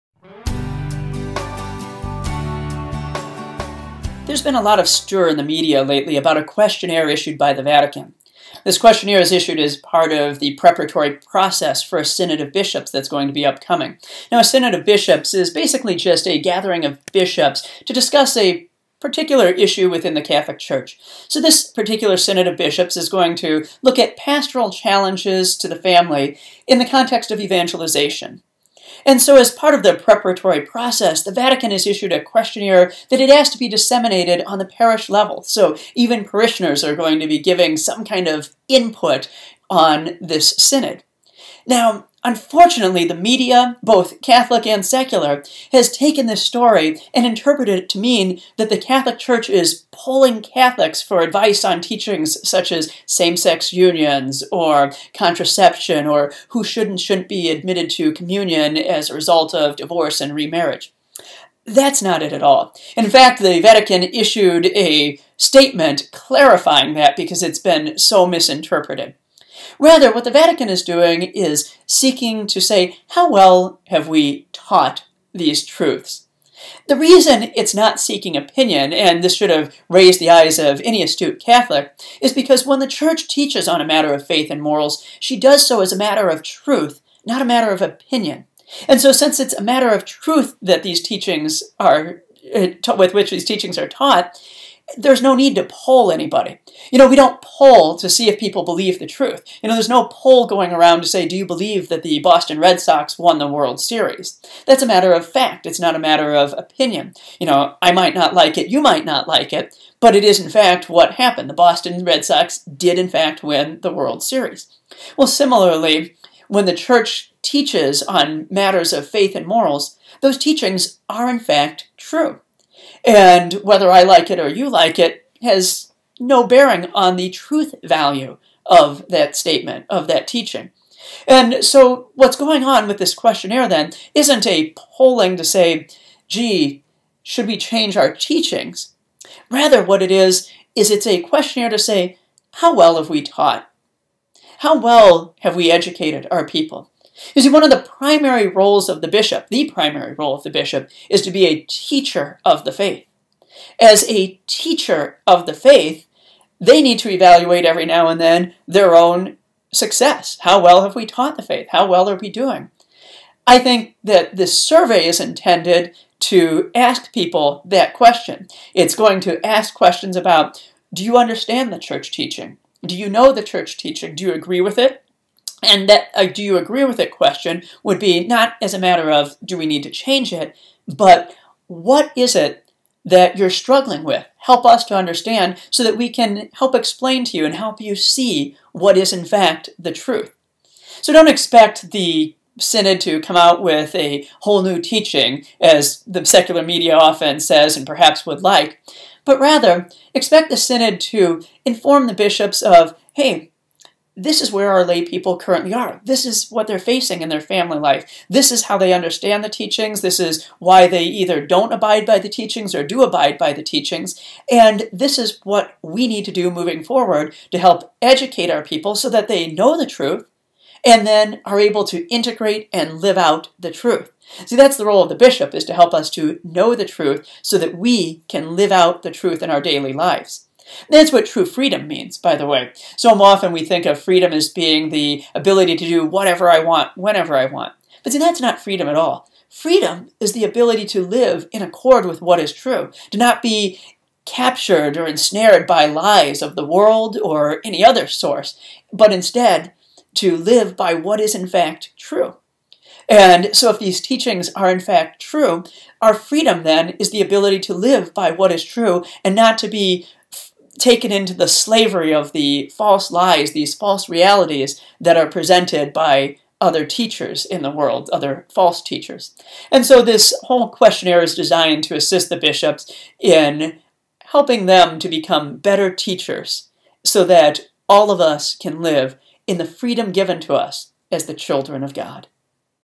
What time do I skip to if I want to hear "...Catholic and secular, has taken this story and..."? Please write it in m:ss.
0:44.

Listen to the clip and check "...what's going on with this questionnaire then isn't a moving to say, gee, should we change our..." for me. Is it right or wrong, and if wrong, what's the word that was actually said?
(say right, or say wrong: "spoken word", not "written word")
wrong: "polling", not "moving".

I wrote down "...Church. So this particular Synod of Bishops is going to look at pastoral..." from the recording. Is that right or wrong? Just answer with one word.
right.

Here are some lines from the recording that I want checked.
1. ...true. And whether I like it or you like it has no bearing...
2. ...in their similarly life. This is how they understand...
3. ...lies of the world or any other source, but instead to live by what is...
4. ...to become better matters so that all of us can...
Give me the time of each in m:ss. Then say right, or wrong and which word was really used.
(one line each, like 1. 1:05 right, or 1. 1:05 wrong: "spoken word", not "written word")
1. 2:01 right
2. 3:27 wrong: "family", not "similarly"
3. 4:05 right
4. 4:34 wrong: "teachers", not "matters".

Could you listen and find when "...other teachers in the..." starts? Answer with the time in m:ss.
4:26.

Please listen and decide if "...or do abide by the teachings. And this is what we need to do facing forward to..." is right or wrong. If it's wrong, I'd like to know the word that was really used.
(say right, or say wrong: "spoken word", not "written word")
wrong: "moving", not "facing".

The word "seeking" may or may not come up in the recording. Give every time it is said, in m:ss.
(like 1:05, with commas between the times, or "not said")
1:11, 1:17.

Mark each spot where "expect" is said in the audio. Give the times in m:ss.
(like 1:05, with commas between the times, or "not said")
3:11, 3:20.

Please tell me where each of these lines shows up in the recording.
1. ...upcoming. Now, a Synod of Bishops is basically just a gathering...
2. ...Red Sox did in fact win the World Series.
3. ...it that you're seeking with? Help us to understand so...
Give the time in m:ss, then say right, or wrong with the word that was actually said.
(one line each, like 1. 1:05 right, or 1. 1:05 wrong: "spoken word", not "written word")
1. 0:13 right
2. 1:52 right
3. 3:02 wrong: "struggling", not "seeking".